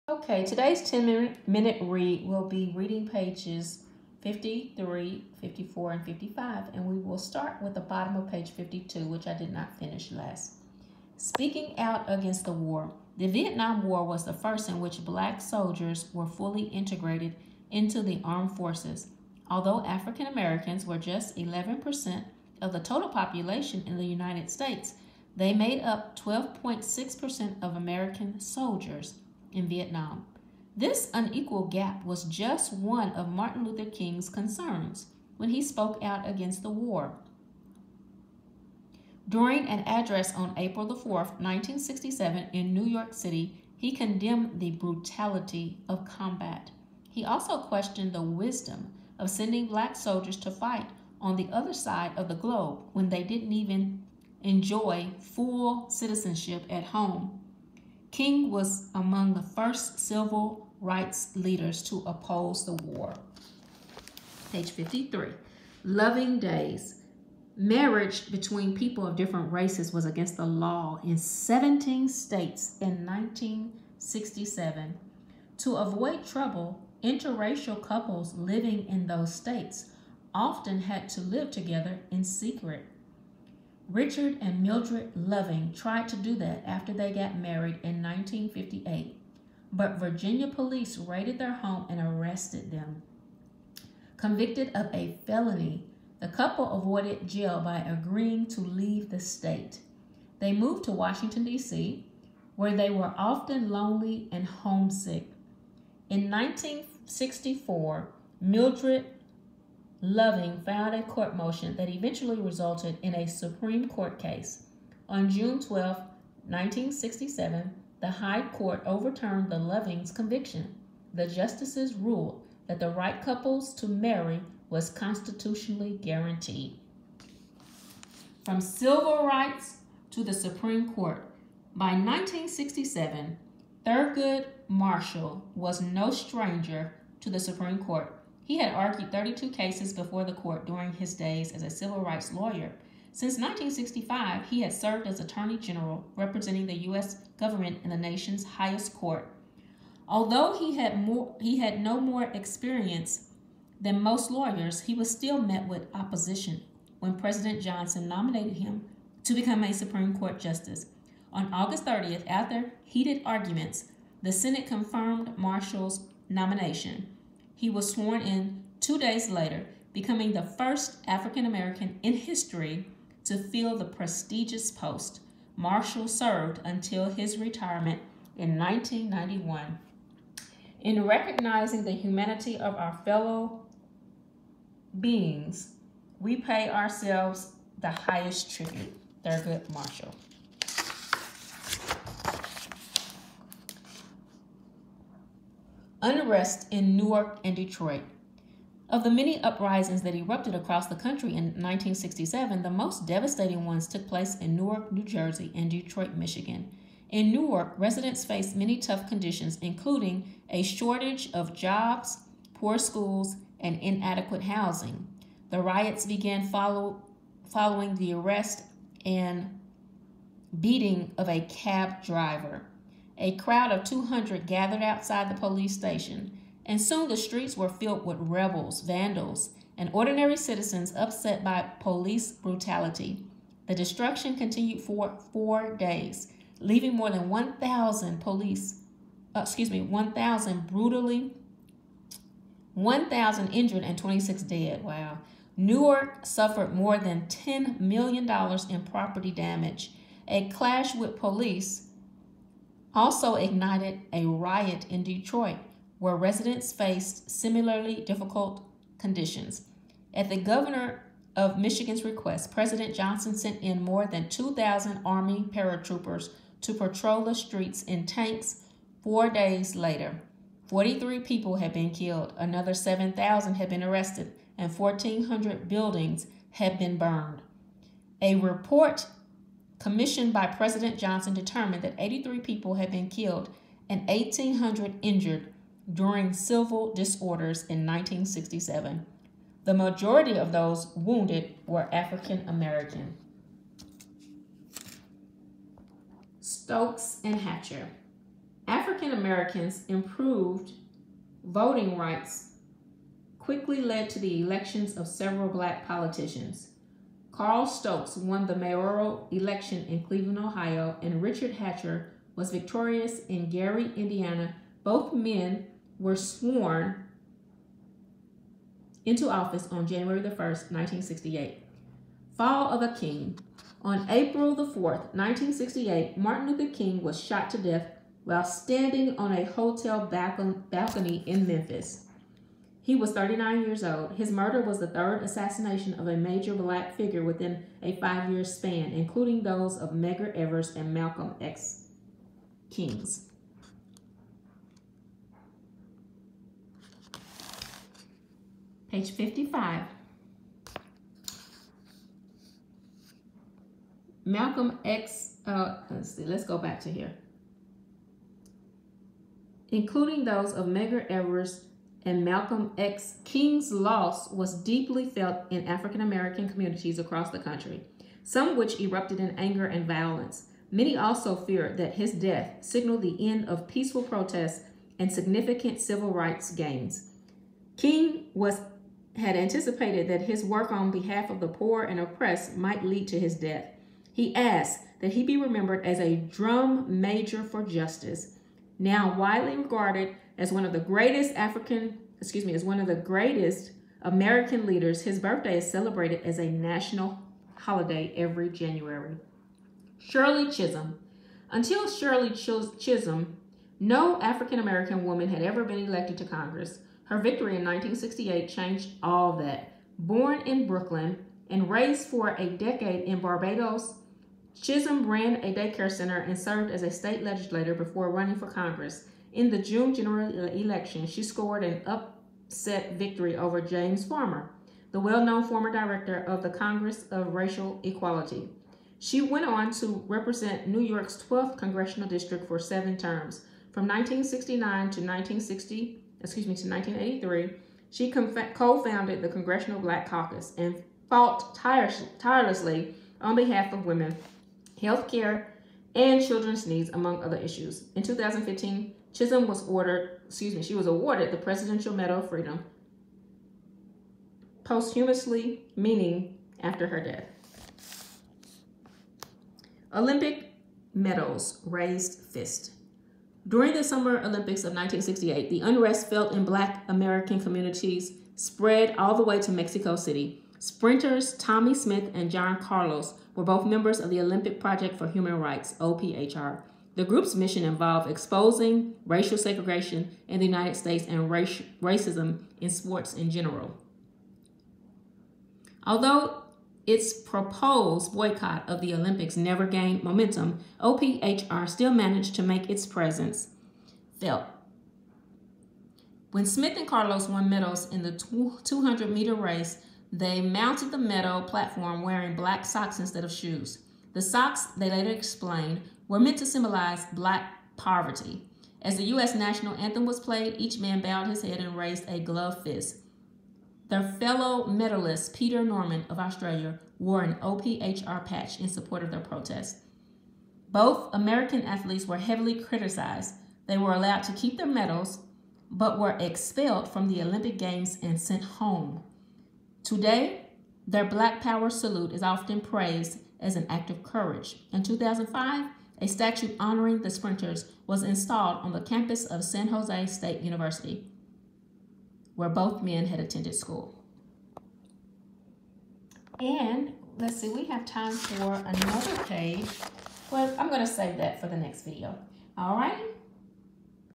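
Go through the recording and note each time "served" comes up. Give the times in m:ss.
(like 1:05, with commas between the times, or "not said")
2:24, 2:56, 6:56.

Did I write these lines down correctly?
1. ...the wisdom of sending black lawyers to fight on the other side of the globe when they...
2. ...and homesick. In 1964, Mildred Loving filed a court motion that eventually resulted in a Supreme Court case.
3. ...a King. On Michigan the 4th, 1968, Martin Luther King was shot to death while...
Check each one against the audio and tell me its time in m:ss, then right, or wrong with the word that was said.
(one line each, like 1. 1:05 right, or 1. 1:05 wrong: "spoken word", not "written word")
1. 0:48 wrong: "soldiers", not "lawyers"
2. 1:44 right
3. 5:22 wrong: "April", not "Michigan".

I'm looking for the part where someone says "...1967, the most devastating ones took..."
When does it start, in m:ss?
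3:21.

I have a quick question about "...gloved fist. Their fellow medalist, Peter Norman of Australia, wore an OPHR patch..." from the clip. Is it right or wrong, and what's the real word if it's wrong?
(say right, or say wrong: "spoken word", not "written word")
right.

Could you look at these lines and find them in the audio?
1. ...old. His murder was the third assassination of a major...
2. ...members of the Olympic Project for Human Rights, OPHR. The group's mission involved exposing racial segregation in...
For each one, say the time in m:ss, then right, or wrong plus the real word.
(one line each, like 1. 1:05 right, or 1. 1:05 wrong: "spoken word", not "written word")
1. 5:33 right
2. 7:53 right.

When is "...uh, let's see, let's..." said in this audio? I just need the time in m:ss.
5:55.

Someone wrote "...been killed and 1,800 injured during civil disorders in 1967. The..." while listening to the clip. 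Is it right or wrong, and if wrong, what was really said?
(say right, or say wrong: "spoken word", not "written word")
right.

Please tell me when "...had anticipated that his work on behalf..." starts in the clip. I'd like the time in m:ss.
6:19.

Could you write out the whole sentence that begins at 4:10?
A clash with police also ignited a riot in Detroit, where residents faced similarly difficult conditions.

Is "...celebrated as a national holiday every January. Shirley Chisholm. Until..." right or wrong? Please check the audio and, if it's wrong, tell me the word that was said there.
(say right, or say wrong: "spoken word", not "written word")
right.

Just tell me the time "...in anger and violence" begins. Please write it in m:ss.
6:09.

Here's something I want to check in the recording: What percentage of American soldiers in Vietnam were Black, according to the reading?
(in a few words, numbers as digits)
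12.6%.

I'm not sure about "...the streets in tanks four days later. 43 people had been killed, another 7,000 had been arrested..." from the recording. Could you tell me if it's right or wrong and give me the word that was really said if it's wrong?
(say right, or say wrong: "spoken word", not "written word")
right.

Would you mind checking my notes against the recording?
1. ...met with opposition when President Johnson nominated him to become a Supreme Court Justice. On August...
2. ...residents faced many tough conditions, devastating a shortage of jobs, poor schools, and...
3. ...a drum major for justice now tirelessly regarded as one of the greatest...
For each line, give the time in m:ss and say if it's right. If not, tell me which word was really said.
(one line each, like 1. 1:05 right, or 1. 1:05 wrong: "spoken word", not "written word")
1. 2:35 right
2. 3:27 wrong: "including", not "devastating"
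3. 6:25 wrong: "widely", not "tirelessly".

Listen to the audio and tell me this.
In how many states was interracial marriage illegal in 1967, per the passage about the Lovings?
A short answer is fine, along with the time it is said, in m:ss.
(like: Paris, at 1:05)
17, at 1:11.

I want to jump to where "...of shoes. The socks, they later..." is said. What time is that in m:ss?
8:23.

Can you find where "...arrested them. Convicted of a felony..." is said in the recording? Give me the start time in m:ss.
1:31.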